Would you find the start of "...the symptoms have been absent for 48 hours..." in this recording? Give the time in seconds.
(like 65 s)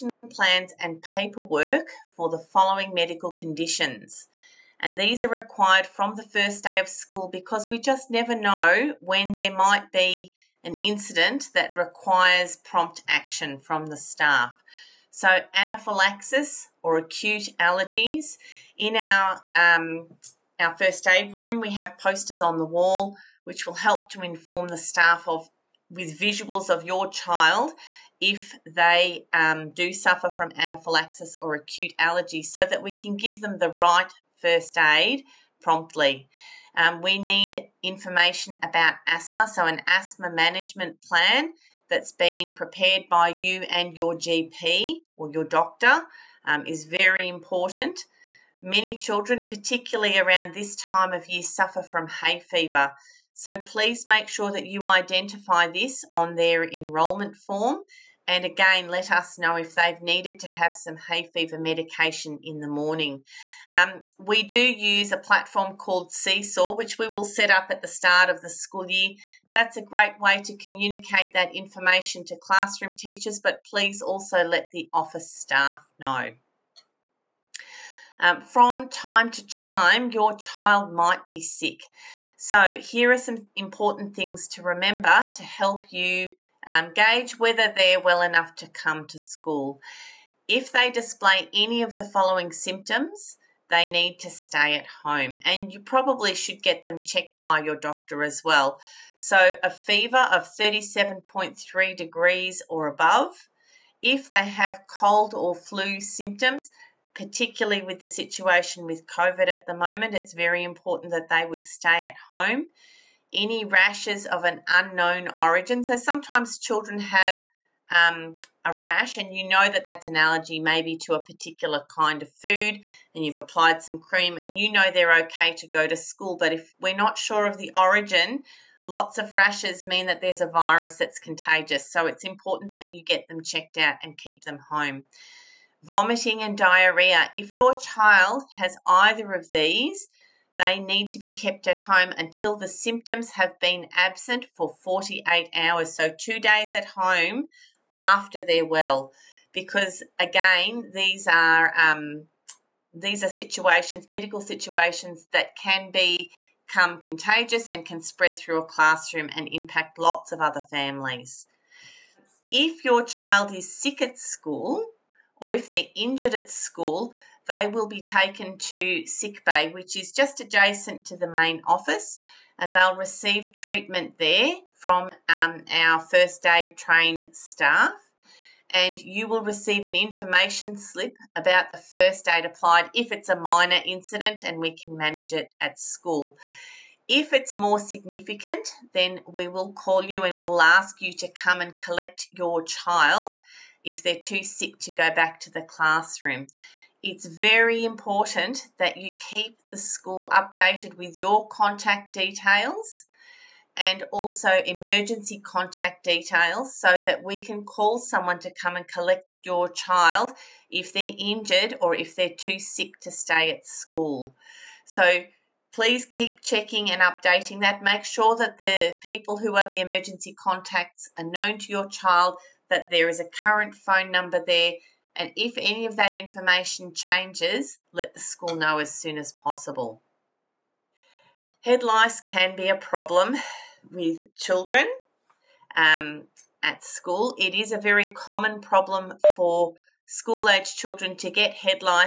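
142 s.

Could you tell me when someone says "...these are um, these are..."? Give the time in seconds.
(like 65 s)
150 s.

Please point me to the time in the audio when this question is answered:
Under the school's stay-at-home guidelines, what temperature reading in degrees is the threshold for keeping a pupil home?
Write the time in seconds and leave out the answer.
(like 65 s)
100 s.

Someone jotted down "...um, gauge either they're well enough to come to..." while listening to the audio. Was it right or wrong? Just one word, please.
wrong.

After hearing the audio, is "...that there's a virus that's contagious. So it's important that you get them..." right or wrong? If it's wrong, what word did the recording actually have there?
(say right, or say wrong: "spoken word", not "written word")
right.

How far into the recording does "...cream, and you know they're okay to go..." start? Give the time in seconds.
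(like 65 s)
123 s.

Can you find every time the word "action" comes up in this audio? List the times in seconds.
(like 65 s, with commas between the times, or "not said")
13 s.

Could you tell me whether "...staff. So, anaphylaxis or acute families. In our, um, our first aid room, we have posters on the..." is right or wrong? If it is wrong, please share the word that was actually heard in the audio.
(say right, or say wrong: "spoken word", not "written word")
wrong: "allergies", not "families".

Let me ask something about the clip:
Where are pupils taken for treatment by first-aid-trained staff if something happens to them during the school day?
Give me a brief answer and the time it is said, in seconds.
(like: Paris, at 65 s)
sick bay, at 169 s.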